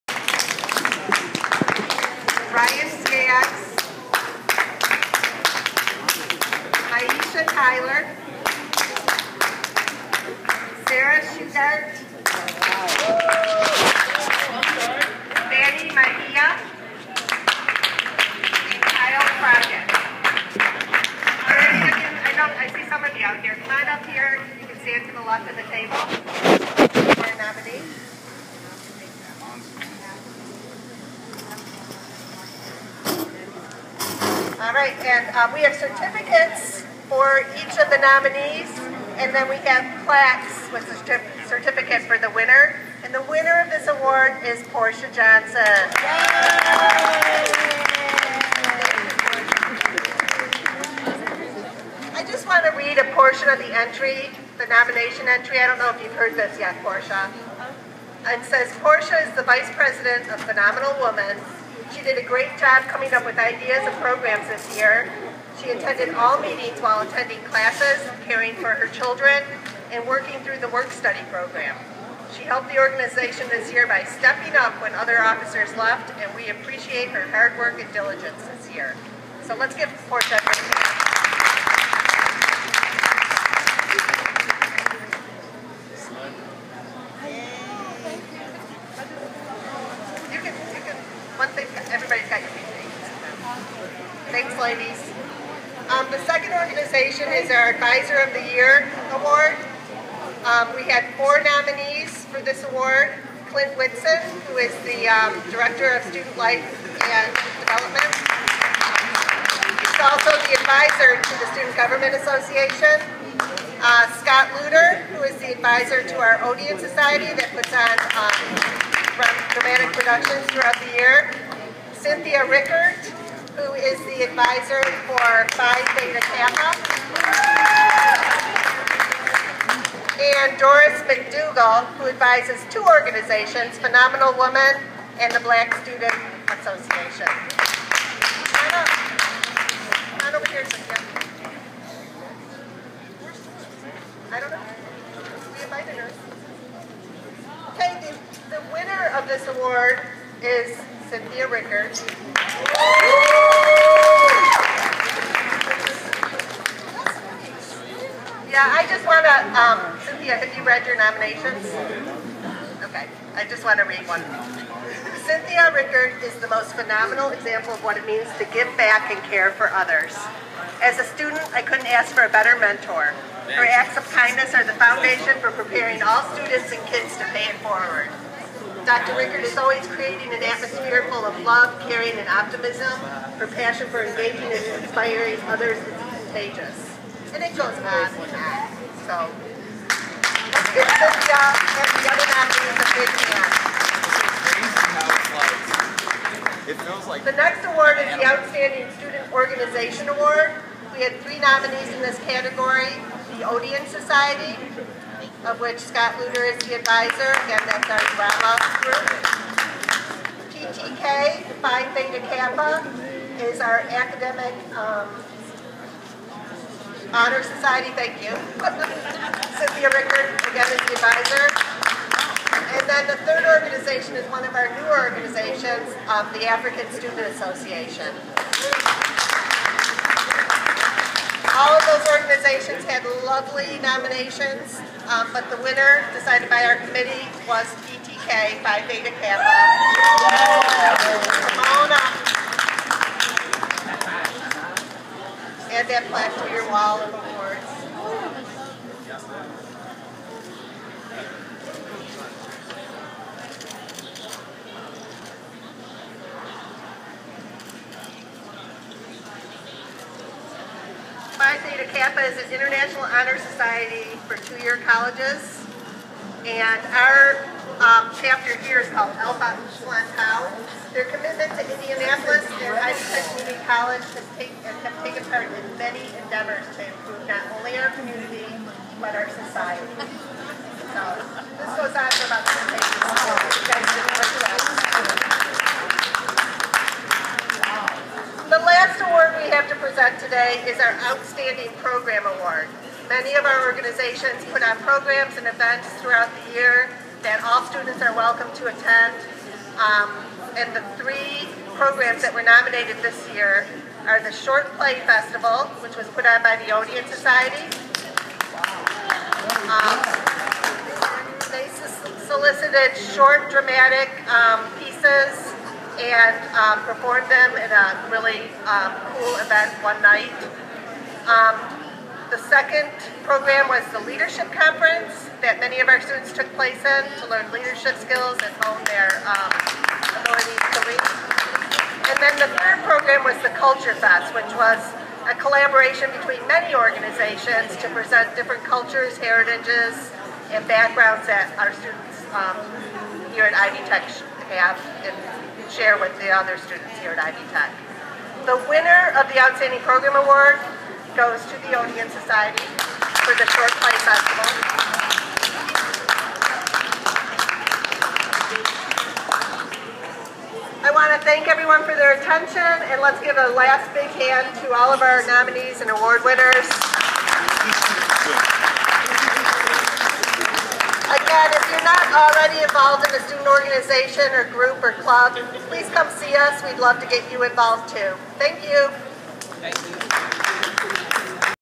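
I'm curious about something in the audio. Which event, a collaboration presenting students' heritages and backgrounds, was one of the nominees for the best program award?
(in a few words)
Culture Fest.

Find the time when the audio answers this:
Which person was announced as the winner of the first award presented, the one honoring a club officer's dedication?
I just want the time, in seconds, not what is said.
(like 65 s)
44 s.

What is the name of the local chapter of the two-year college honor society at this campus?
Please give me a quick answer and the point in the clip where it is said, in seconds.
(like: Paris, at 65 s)
Alpha Upsilon, at 269 s.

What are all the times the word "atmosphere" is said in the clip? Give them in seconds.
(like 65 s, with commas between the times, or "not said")
180 s.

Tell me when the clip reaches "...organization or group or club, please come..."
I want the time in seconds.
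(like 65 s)
373 s.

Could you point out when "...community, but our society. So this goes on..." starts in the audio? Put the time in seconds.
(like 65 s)
277 s.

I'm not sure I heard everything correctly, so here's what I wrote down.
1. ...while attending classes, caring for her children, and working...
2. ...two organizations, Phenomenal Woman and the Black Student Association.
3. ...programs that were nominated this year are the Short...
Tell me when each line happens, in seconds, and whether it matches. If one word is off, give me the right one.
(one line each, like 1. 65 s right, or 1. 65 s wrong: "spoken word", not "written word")
1. 66 s right
2. 132 s right
3. 301 s right.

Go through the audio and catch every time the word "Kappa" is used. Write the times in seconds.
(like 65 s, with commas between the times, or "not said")
126 s, 212 s, 239 s, 261 s.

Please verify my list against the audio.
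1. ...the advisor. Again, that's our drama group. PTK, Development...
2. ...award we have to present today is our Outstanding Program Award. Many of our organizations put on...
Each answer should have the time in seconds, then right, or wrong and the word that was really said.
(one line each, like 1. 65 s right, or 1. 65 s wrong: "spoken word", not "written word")
1. 206 s wrong: "Phi", not "Development"
2. 289 s right.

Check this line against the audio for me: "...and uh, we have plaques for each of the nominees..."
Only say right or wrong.
wrong.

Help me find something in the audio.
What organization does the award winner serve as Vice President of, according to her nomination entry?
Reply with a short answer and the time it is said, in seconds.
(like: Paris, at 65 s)
Phenomenal Women, at 60 s.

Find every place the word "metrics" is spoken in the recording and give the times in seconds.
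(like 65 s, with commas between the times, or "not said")
not said.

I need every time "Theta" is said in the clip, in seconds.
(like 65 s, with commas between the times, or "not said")
125 s, 211 s, 238 s, 261 s.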